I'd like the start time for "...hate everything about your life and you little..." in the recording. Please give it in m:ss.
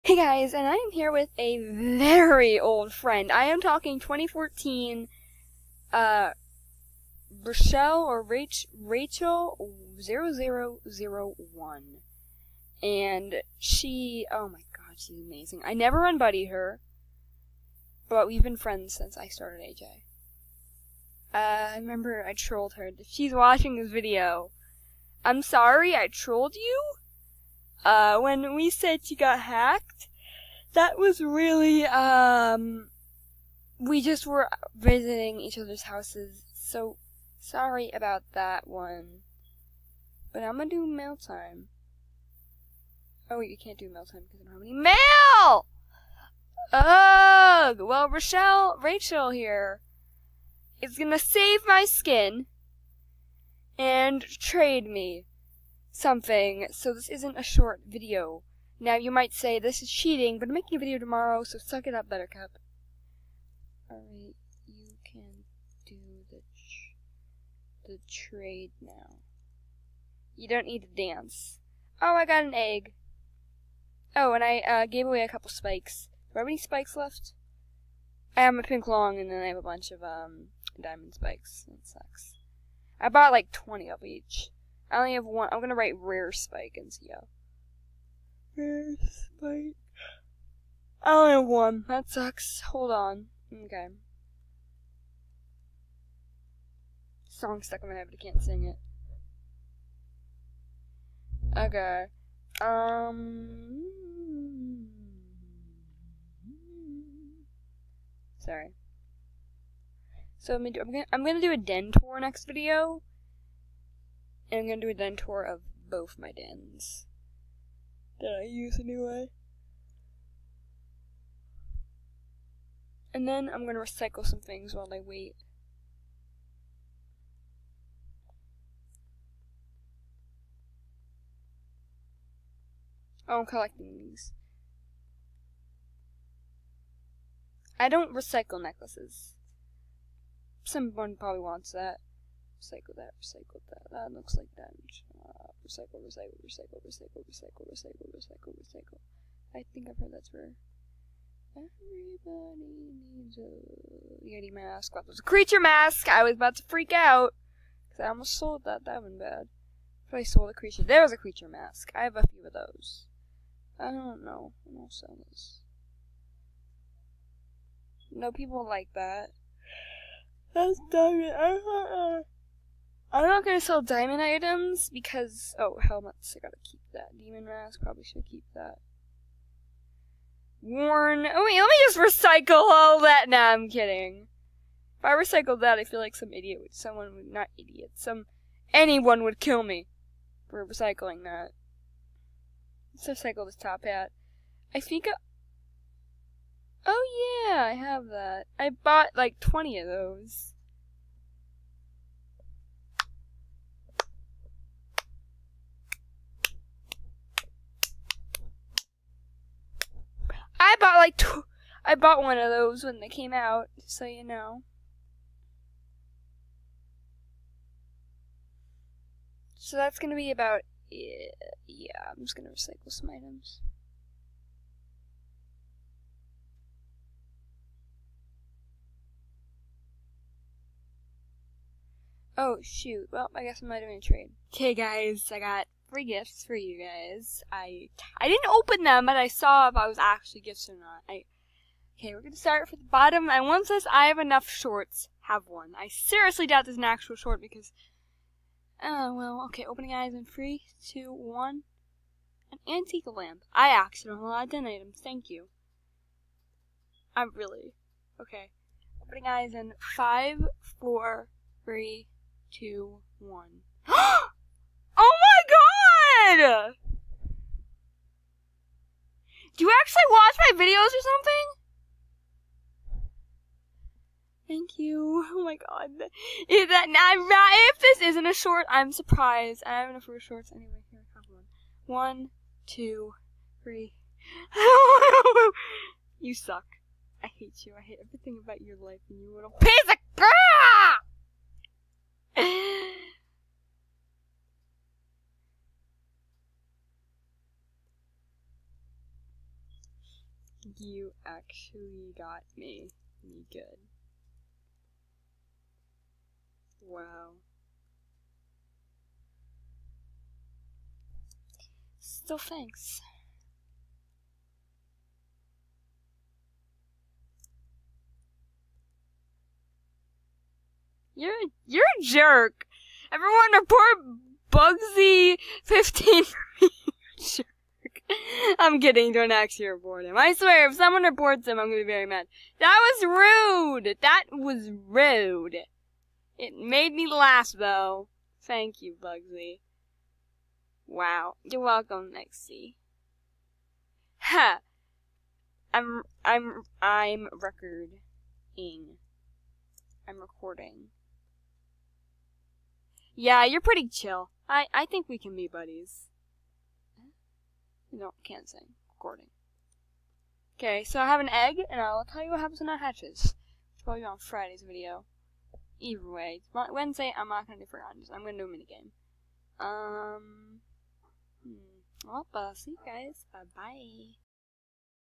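4:47.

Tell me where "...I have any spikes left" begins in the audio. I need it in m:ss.
1:16.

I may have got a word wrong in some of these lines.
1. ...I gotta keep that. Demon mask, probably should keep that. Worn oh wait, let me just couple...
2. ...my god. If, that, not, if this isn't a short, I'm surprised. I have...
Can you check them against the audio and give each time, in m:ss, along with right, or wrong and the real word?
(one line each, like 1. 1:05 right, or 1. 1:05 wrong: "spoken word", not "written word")
1. 2:56 wrong: "recycle", not "couple"
2. 4:35 right.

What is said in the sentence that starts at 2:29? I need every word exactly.
I think I've heard that's where everybody needs a Yeti mask.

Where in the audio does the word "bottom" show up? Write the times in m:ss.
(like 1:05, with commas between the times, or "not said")
4:02.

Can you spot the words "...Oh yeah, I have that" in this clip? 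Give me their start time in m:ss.
3:16.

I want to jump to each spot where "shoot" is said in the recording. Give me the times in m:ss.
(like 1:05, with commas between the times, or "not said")
3:52.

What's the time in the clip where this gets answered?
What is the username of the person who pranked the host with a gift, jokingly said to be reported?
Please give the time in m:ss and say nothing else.
5:24.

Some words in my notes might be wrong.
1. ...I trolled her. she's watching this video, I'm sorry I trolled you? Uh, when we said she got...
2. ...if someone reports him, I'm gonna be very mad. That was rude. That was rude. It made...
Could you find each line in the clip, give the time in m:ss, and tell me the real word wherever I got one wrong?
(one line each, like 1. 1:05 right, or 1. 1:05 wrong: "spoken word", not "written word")
1. 0:22 right
2. 5:30 right.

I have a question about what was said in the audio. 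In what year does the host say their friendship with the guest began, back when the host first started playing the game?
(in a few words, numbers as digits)
2014.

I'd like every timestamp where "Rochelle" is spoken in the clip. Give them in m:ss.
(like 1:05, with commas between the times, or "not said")
0:07, 0:48.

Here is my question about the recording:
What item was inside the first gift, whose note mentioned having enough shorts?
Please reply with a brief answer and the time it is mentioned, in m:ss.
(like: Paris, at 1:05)
An antique lamp, at 4:12.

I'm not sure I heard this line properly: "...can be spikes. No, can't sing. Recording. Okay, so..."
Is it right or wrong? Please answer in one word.
wrong.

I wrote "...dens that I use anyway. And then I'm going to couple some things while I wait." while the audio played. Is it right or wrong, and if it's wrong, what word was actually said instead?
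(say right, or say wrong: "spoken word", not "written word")
wrong: "recycle", not "couple".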